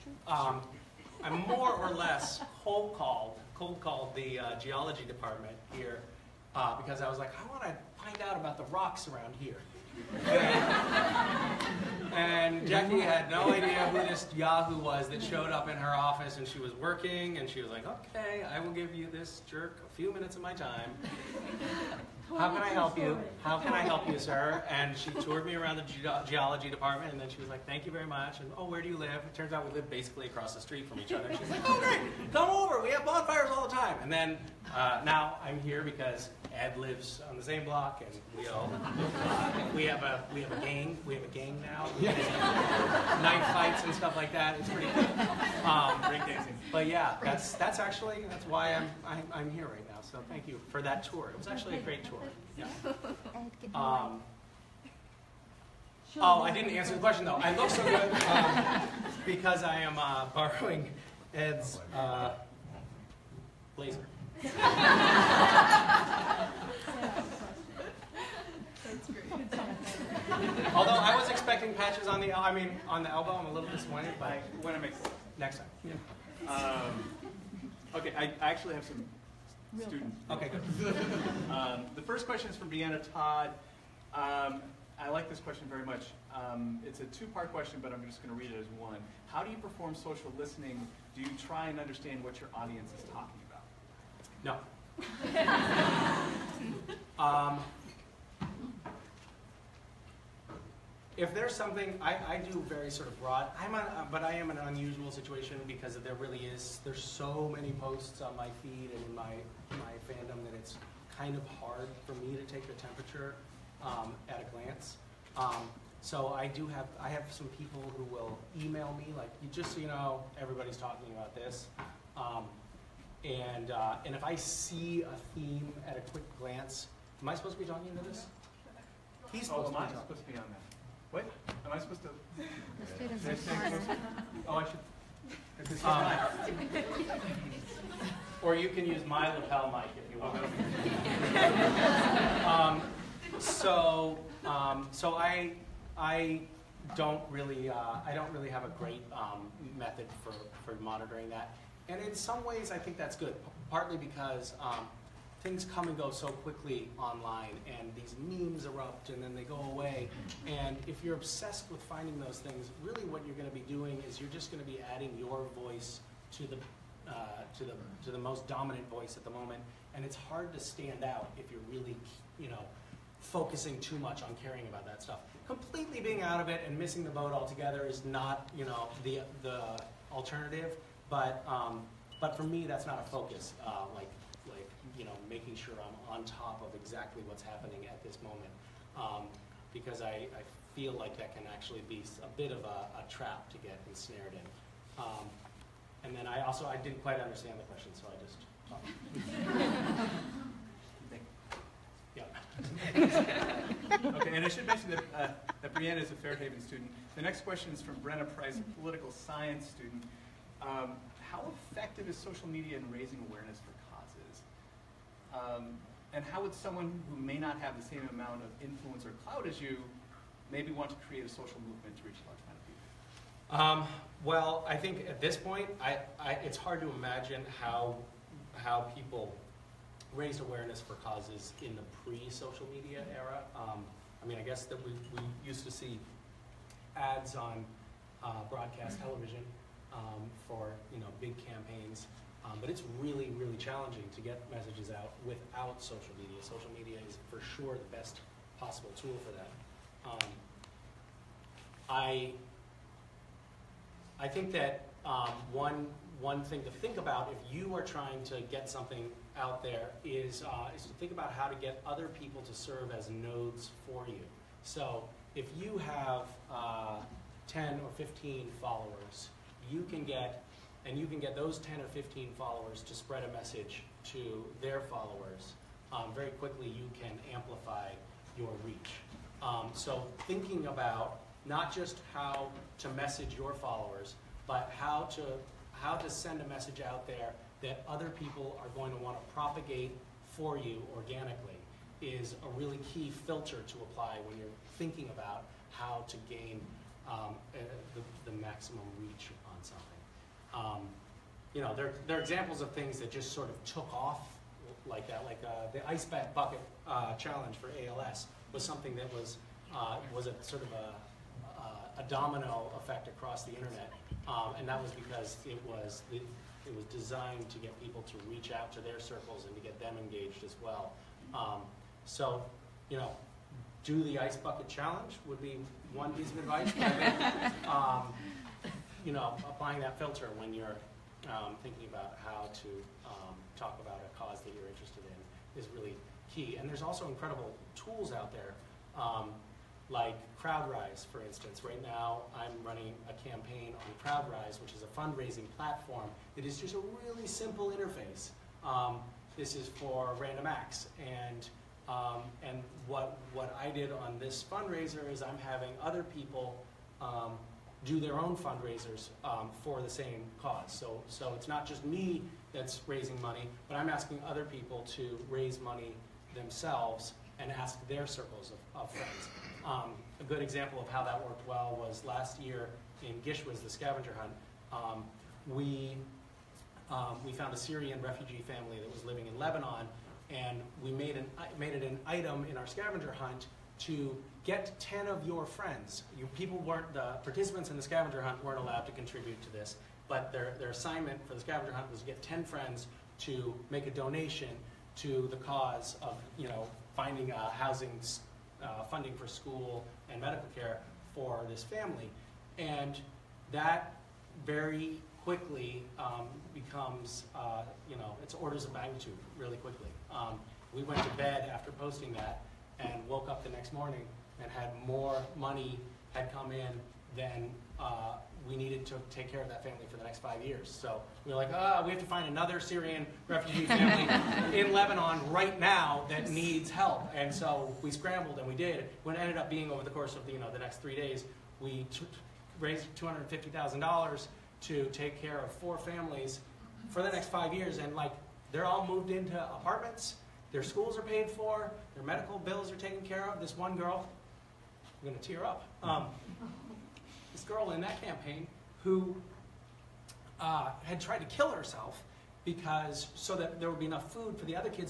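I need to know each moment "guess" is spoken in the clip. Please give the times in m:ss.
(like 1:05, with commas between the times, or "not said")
3:54.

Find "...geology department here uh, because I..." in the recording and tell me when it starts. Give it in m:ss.
0:04.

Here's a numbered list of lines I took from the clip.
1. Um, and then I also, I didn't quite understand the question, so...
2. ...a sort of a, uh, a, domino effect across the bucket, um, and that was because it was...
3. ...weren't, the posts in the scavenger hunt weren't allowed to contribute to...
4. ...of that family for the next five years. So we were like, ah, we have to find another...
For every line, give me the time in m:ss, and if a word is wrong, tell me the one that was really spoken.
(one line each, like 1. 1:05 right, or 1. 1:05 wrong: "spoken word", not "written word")
1. 3:15 right
2. 5:10 wrong: "internet", not "bucket"
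3. 6:26 wrong: "participants", not "posts"
4. 6:59 right.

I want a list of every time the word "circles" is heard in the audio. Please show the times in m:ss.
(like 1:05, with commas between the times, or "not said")
5:18, 6:08.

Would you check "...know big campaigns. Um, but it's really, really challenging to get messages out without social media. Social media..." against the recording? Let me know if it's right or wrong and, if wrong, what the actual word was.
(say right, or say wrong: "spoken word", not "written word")
right.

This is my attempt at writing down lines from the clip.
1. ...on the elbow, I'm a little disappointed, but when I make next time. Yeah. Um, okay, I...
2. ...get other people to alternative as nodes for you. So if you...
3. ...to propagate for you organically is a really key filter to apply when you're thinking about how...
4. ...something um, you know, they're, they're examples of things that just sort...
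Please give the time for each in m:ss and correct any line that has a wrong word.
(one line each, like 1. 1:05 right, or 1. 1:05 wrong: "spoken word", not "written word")
1. 1:12 right
2. 4:21 wrong: "serve", not "alternative"
3. 4:49 right
4. 4:59 right.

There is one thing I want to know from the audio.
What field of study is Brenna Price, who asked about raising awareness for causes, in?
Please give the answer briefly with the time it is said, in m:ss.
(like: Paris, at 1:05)
Political science, at 3:28.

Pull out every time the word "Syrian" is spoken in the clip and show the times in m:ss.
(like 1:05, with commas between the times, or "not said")
6:17, 7:02.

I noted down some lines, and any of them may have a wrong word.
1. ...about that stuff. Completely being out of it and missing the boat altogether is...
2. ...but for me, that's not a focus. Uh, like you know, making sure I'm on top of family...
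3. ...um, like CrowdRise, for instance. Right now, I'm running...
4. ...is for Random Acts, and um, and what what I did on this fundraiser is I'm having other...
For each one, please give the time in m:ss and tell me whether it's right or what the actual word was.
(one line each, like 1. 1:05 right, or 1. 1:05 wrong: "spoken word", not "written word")
1. 2:54 right
2. 3:02 wrong: "exactly", not "family"
3. 5:39 right
4. 5:49 right.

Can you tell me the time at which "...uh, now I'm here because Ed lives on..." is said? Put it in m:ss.
0:34.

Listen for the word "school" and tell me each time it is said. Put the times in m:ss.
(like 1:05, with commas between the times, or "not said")
6:39, 7:20.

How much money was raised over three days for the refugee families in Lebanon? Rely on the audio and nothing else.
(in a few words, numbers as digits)
$250,000.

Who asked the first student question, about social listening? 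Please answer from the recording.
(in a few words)
Deanna Todd.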